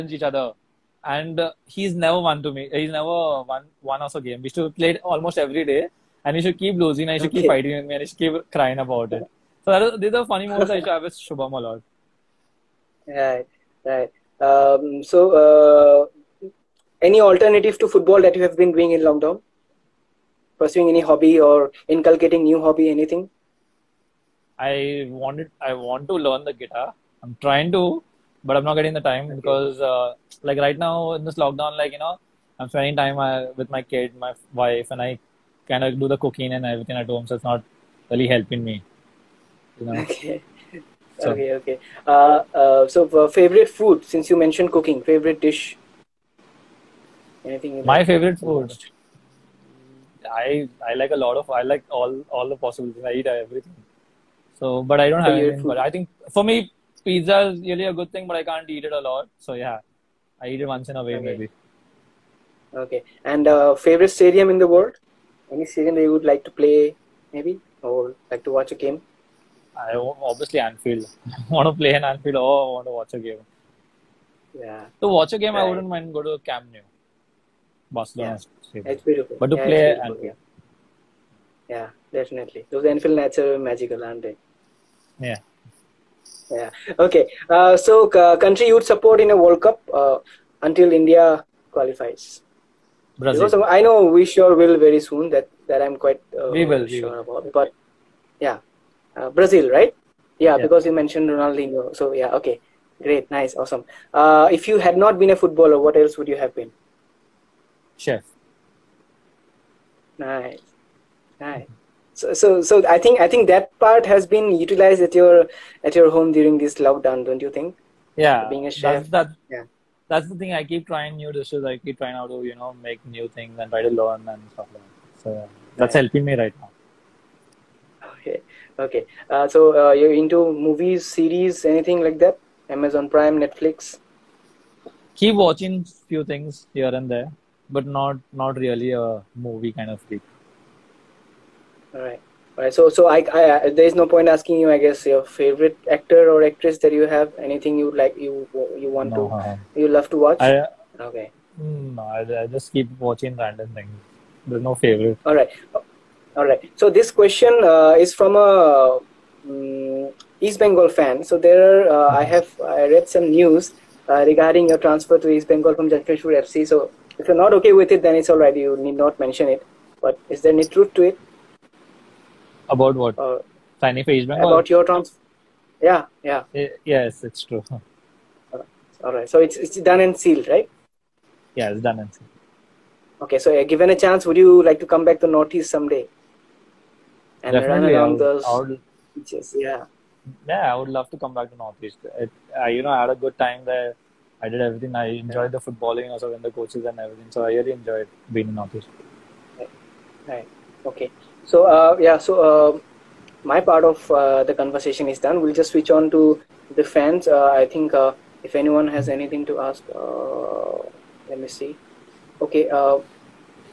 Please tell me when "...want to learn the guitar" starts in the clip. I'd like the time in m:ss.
0:25.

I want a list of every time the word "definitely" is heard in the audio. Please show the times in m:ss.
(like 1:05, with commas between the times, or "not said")
1:22, 3:07.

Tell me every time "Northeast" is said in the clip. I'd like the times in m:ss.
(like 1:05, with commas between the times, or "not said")
3:05, 3:11, 3:18.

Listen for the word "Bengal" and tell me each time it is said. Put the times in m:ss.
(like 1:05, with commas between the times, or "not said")
2:40, 2:45.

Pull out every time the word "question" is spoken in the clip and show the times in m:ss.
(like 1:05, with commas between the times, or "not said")
2:37.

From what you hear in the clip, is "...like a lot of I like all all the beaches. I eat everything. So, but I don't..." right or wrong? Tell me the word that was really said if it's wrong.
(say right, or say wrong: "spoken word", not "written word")
wrong: "possibilities", not "beaches".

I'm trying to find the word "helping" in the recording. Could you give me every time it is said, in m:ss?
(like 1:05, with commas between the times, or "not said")
0:38, 2:06.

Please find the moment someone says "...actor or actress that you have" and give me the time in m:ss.
2:25.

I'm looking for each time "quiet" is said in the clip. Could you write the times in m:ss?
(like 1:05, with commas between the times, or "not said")
not said.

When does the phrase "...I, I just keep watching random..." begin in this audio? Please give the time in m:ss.
2:32.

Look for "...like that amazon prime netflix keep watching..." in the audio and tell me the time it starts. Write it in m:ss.
2:12.